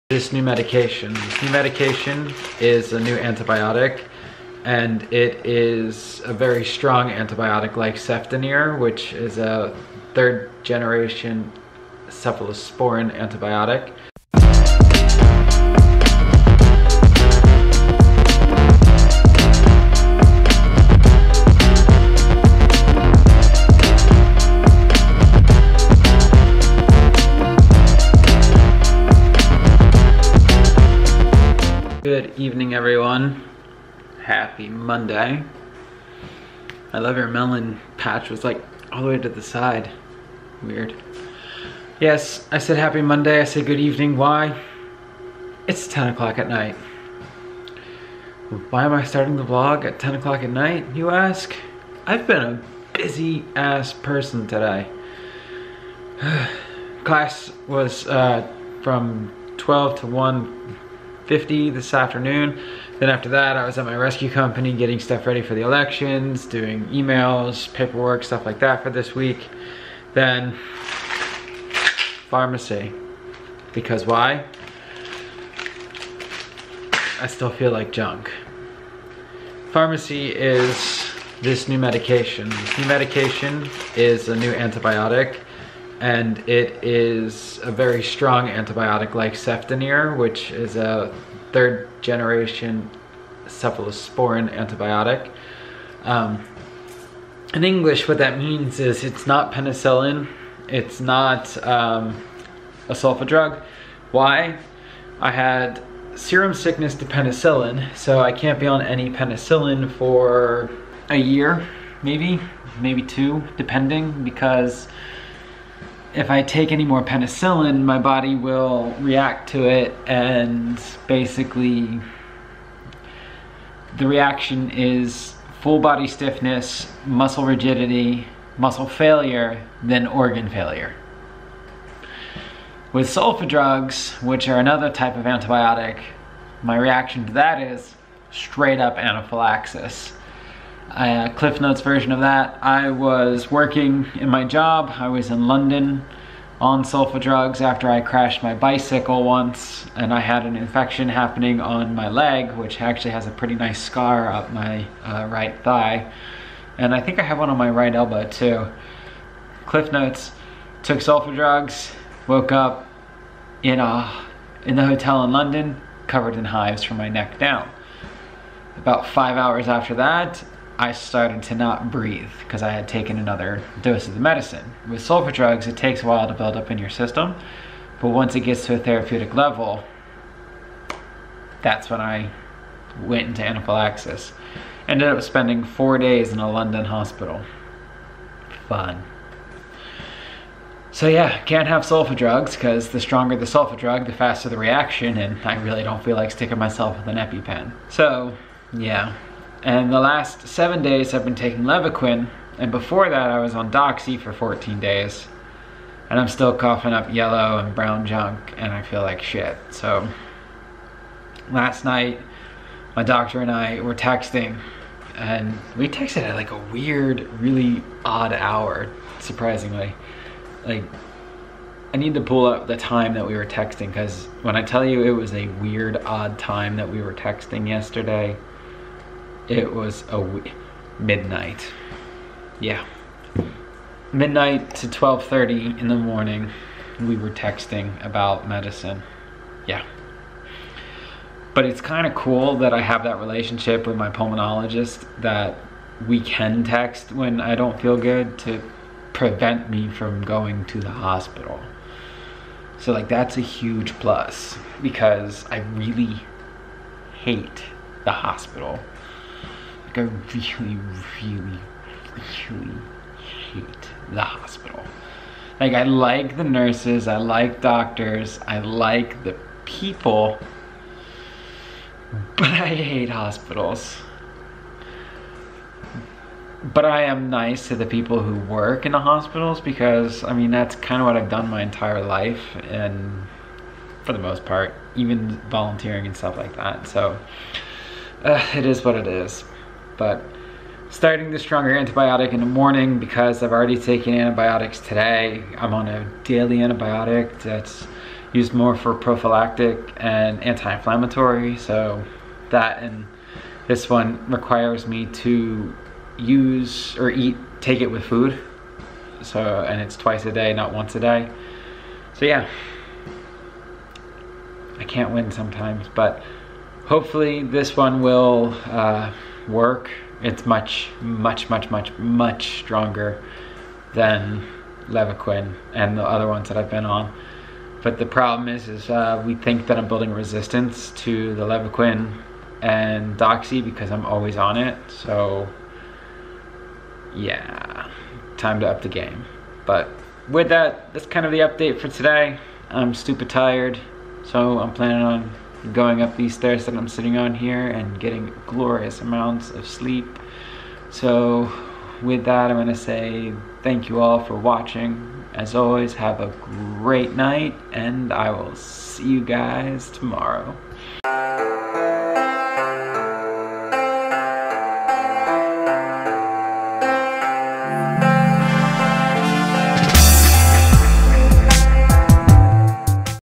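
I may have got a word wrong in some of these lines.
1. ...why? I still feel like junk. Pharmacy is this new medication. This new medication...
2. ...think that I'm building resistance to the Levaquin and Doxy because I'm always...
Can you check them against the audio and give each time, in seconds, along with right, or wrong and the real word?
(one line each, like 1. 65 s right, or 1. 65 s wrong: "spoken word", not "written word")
1. 74 s right
2. 329 s right.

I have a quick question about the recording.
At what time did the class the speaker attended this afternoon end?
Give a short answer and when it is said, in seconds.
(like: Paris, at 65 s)
1:50, at 60 s.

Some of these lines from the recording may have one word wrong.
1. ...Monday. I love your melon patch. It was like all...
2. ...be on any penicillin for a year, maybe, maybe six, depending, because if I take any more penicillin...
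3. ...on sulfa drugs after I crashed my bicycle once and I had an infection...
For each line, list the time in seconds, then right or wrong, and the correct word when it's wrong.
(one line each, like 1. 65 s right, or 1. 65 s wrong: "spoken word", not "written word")
1. 34 s right
2. 108 s wrong: "two", not "six"
3. 146 s right.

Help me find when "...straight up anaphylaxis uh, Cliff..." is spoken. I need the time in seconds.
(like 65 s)
138 s.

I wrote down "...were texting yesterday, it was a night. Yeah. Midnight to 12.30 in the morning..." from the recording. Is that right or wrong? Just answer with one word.
wrong.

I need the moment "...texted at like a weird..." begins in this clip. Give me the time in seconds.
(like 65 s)
215 s.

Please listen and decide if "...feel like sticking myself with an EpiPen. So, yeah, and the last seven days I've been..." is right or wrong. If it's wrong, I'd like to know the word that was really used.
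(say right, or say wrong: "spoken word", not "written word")
right.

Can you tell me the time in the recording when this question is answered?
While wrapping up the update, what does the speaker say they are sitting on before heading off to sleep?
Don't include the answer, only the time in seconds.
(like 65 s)
346 s.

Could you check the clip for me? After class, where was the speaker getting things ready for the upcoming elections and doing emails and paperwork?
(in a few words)
rescue company.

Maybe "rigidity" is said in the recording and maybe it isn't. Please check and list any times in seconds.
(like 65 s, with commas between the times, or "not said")
127 s.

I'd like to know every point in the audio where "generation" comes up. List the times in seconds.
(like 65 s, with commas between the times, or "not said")
10 s, 92 s.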